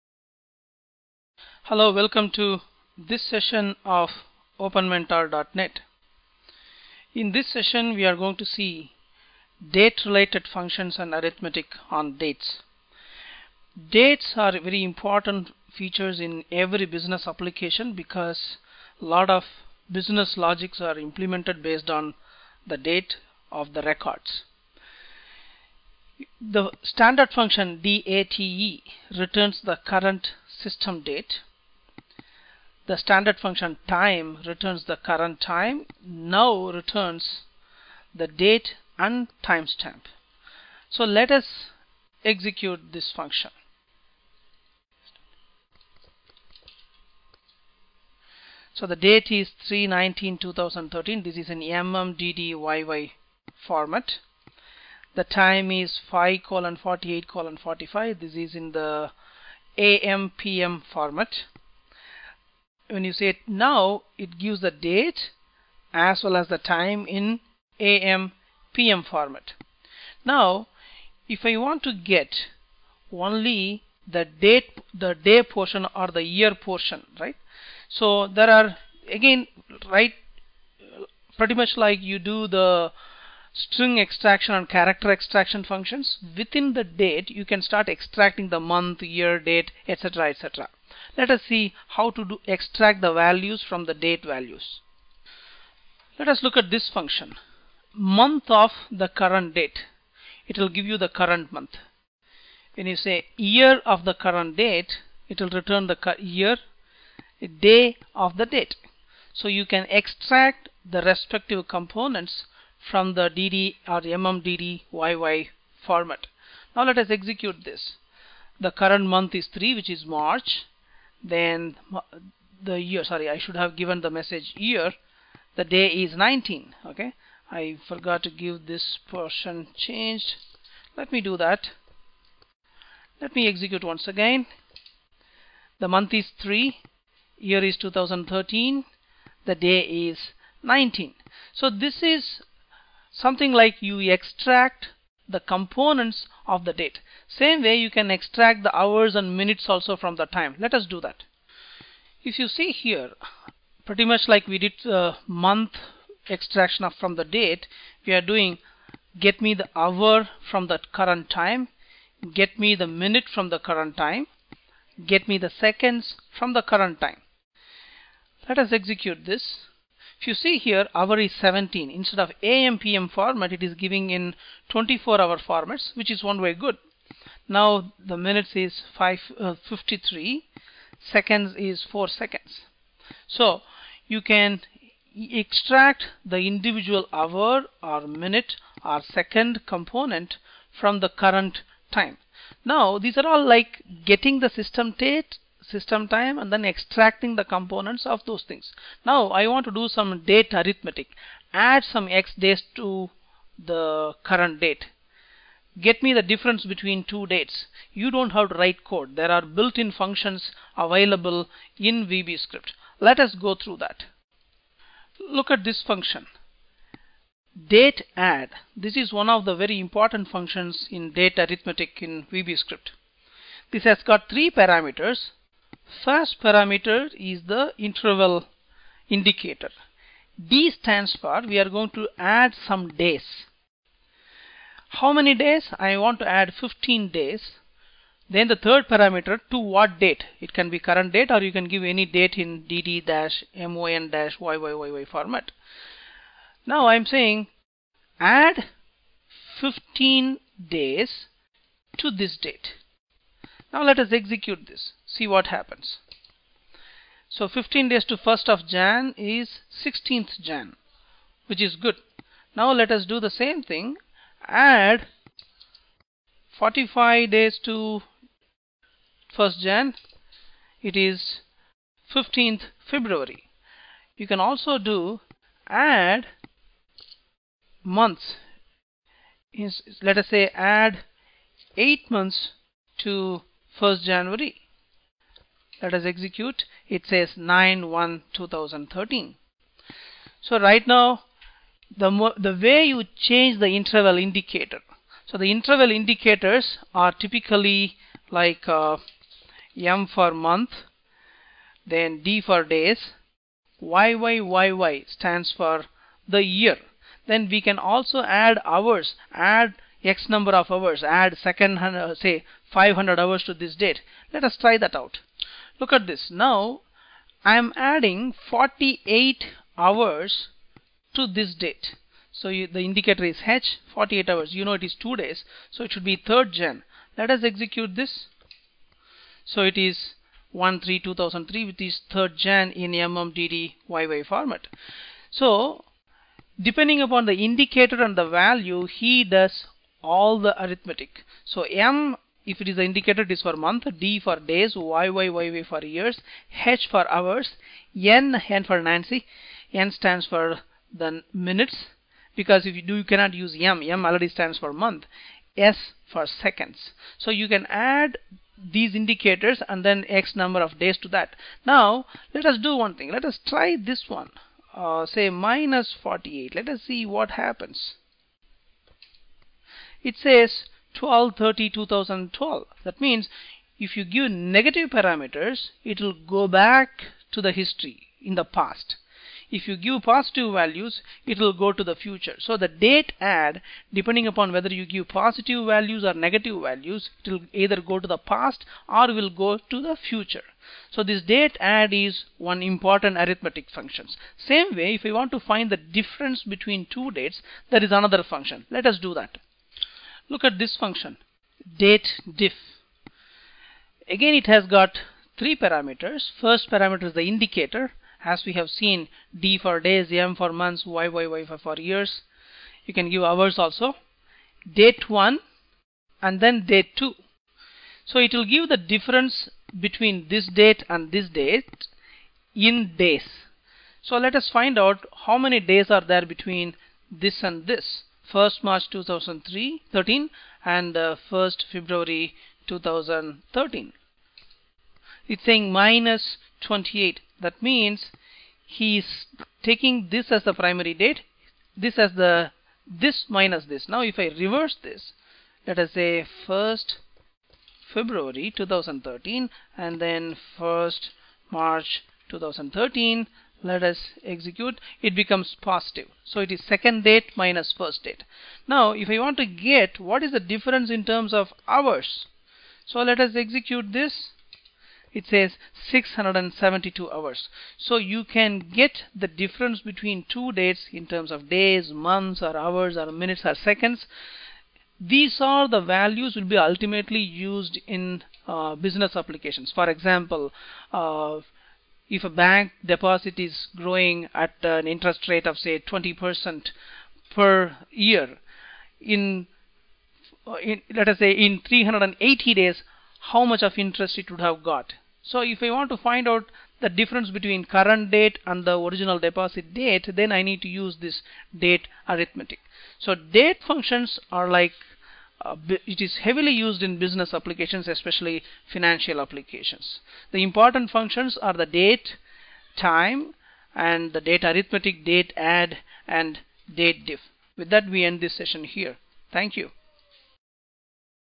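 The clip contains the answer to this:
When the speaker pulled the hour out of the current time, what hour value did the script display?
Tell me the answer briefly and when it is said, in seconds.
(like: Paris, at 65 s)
17, at 170 s.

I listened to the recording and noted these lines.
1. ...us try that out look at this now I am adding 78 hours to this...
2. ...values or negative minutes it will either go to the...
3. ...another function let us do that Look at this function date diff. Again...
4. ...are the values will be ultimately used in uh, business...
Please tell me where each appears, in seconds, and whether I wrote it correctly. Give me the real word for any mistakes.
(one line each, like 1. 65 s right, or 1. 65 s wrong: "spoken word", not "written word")
1. 314 s wrong: "48", not "78"
2. 385 s wrong: "values", not "minutes"
3. 397 s right
4. 475 s right.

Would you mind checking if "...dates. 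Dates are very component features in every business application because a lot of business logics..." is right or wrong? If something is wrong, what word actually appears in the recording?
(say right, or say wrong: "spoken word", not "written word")
wrong: "important", not "component".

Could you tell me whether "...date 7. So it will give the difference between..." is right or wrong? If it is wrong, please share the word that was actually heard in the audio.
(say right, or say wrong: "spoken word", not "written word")
wrong: "2", not "7".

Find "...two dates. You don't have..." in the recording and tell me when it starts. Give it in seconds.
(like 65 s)
207 s.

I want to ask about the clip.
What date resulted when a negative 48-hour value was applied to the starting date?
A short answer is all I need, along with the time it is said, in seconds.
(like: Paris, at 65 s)
12/30/2012, at 370 s.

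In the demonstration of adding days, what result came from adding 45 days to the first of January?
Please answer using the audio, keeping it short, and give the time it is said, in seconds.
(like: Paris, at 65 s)
15th February, at 272 s.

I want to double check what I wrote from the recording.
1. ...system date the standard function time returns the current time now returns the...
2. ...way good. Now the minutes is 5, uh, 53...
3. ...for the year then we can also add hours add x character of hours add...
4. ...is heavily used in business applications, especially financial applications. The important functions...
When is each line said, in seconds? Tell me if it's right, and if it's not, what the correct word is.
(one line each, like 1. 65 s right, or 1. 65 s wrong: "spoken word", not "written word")
1. 30 s right
2. 176 s right
3. 305 s wrong: "number", not "character"
4. 506 s right.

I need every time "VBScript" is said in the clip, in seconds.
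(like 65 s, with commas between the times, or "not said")
212 s, 222 s.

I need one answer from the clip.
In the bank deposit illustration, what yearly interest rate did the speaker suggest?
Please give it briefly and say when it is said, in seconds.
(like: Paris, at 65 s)
20%, at 485 s.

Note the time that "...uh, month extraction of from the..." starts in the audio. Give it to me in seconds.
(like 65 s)
154 s.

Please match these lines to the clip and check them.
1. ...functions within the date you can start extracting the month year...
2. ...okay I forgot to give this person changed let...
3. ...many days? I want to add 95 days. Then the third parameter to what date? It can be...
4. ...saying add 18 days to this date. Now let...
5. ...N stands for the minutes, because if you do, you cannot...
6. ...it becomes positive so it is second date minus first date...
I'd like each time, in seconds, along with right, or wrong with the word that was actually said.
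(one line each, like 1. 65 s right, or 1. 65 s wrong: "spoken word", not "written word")
1. 85 s right
2. 126 s right
3. 235 s wrong: "15", not "95"
4. 247 s wrong: "15", not "18"
5. 349 s right
6. 455 s right.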